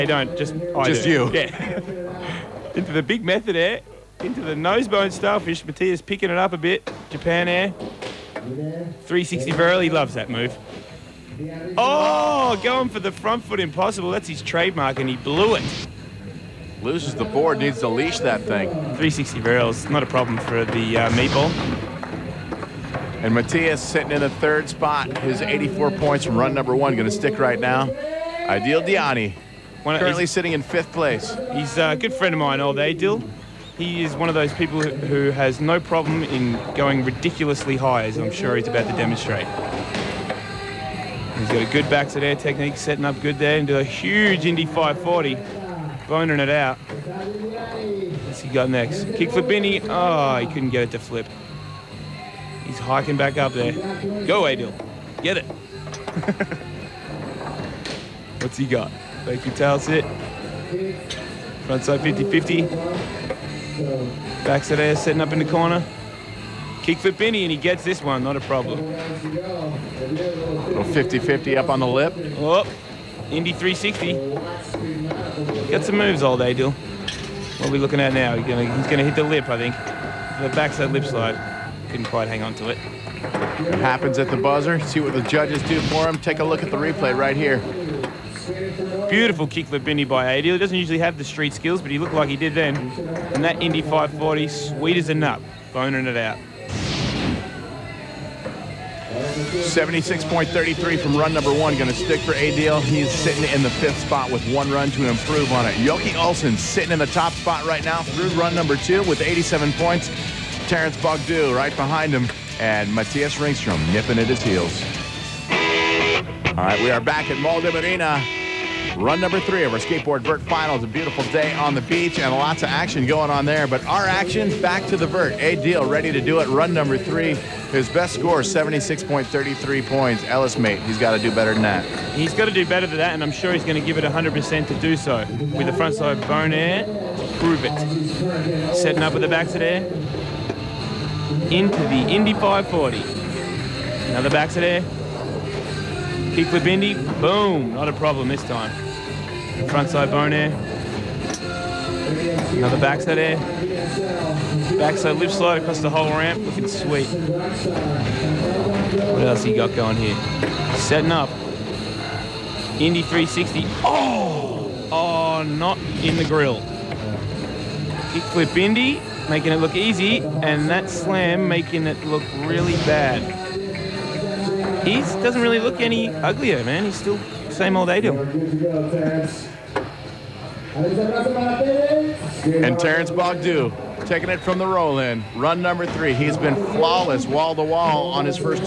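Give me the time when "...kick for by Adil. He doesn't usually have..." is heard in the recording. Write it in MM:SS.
01:29.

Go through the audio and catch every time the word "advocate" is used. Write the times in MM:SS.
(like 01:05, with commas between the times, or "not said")
not said.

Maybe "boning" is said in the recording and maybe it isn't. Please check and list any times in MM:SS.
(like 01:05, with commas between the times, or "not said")
00:46, 01:35.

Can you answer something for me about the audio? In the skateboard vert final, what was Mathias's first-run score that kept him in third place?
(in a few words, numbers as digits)
84.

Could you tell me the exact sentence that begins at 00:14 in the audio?
That's his trademark, and he blew it.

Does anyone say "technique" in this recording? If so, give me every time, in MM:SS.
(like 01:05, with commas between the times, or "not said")
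00:42.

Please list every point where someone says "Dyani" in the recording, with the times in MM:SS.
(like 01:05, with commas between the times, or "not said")
00:28.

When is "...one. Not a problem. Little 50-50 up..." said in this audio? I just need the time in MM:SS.
01:08.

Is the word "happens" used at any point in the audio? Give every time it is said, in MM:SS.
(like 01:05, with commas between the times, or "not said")
01:23.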